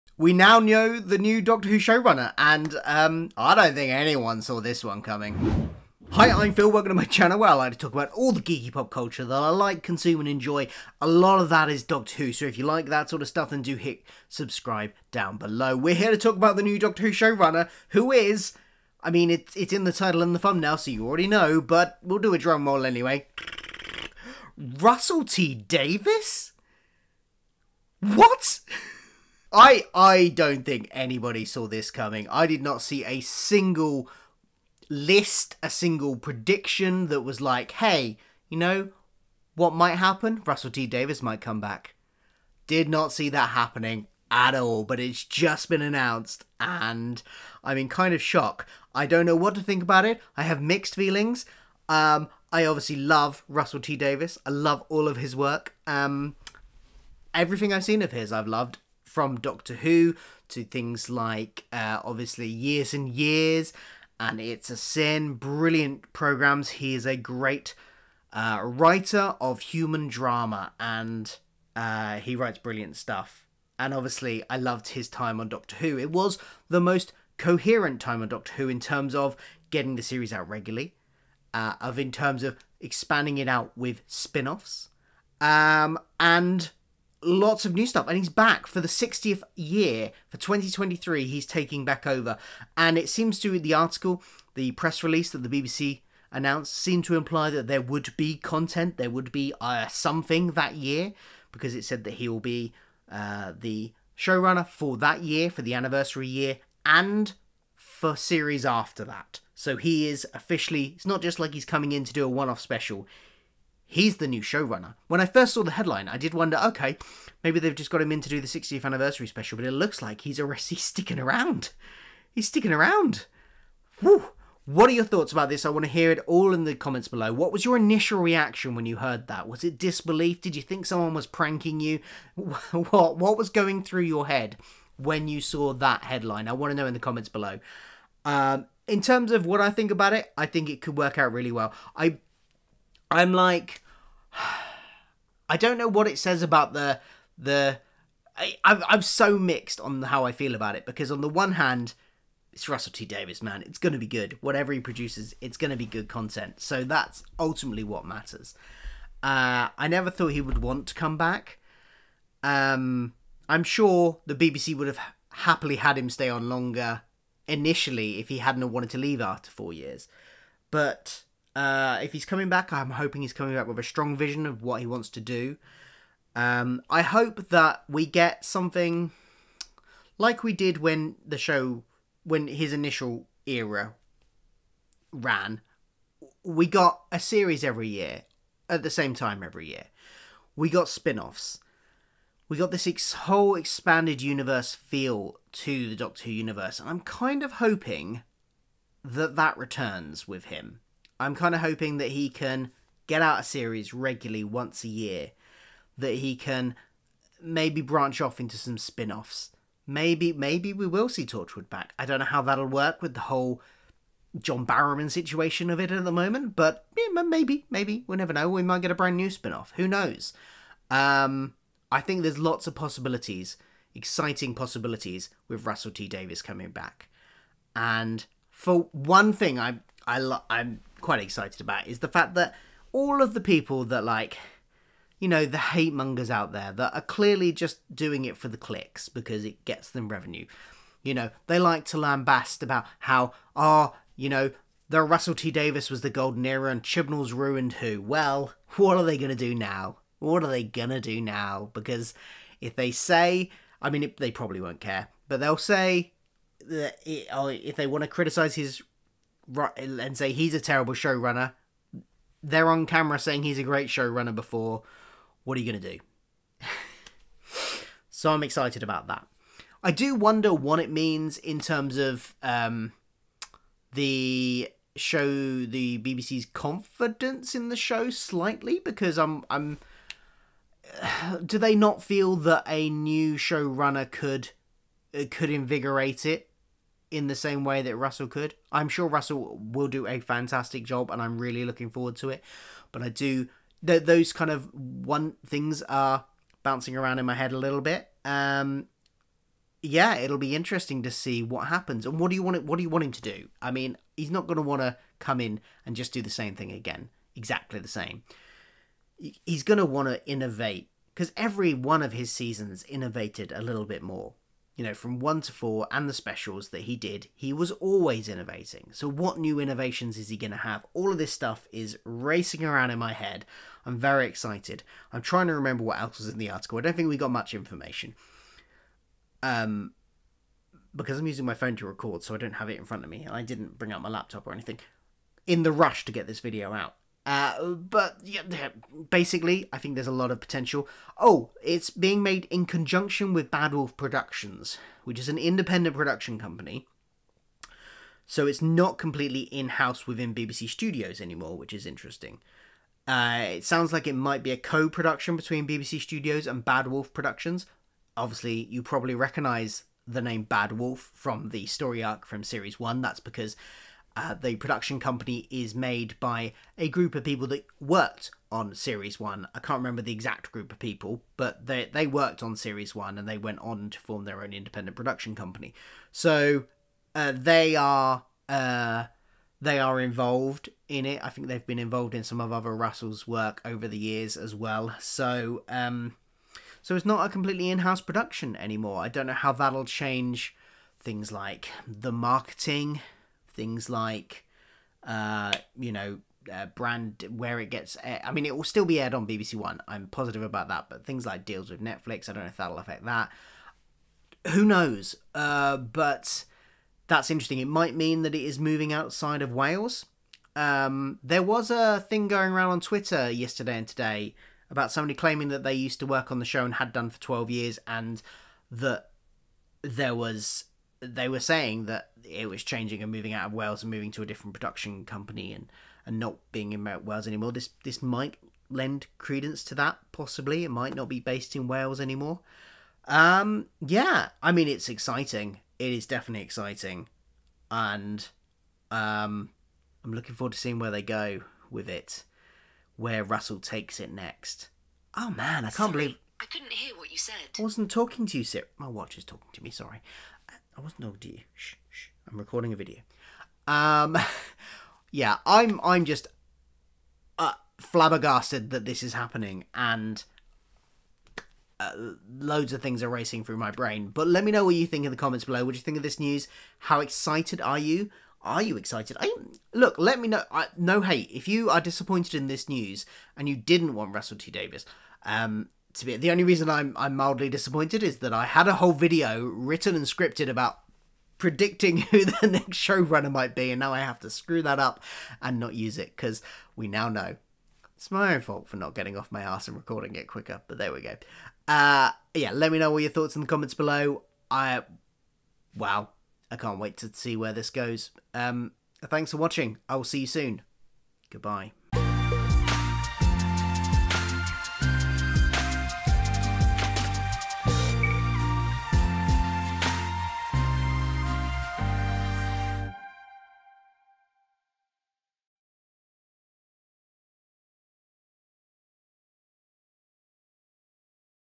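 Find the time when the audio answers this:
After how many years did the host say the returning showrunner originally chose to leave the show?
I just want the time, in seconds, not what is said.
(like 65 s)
169 s.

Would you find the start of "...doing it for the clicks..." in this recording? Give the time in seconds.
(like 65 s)
237 s.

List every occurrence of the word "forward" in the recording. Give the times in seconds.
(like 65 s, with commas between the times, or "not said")
291 s, 440 s.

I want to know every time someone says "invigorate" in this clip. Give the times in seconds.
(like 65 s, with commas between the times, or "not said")
285 s.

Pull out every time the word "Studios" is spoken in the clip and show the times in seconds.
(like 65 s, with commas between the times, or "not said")
350 s, 355 s.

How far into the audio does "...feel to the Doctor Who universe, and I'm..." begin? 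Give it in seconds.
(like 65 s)
194 s.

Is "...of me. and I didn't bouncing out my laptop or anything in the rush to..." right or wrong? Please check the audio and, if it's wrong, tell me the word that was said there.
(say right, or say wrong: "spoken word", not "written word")
wrong: "bring", not "bouncing".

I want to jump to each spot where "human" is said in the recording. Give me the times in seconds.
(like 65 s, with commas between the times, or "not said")
69 s.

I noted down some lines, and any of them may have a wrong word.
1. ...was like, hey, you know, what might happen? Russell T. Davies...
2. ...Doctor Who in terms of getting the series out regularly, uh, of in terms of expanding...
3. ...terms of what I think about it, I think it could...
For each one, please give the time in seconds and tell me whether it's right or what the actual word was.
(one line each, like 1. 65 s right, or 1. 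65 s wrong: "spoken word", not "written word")
1. 37 s right
2. 78 s right
3. 139 s right.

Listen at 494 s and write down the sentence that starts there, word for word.
I wow, I can't wait to see where this goes.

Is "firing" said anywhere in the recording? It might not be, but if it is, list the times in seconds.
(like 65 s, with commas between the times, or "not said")
not said.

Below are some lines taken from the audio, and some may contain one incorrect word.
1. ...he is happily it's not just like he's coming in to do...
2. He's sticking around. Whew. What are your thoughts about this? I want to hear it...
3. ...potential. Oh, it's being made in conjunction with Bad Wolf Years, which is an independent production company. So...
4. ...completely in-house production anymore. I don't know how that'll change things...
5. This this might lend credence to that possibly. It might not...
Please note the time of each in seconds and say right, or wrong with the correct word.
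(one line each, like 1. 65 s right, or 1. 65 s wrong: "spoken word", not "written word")
1. 109 s wrong: "officially", not "happily"
2. 122 s right
3. 340 s wrong: "Productions", not "Years"
4. 387 s right
5. 427 s right.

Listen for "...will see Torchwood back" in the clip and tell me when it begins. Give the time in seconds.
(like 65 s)
210 s.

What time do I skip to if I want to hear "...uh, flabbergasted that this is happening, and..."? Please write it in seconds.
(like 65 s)
457 s.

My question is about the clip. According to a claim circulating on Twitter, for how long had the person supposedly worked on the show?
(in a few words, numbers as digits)
12 years.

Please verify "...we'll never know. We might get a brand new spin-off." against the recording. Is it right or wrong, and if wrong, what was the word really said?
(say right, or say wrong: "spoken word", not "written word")
right.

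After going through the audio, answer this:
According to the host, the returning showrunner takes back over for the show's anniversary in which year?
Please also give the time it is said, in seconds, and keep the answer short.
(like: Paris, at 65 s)
2023, at 90 s.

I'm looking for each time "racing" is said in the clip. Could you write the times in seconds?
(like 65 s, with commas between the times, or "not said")
322 s, 463 s.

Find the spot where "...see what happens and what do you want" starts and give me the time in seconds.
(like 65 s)
301 s.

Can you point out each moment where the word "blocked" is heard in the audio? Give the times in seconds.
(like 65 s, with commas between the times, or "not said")
not said.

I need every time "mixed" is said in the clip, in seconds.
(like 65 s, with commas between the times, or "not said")
50 s, 149 s.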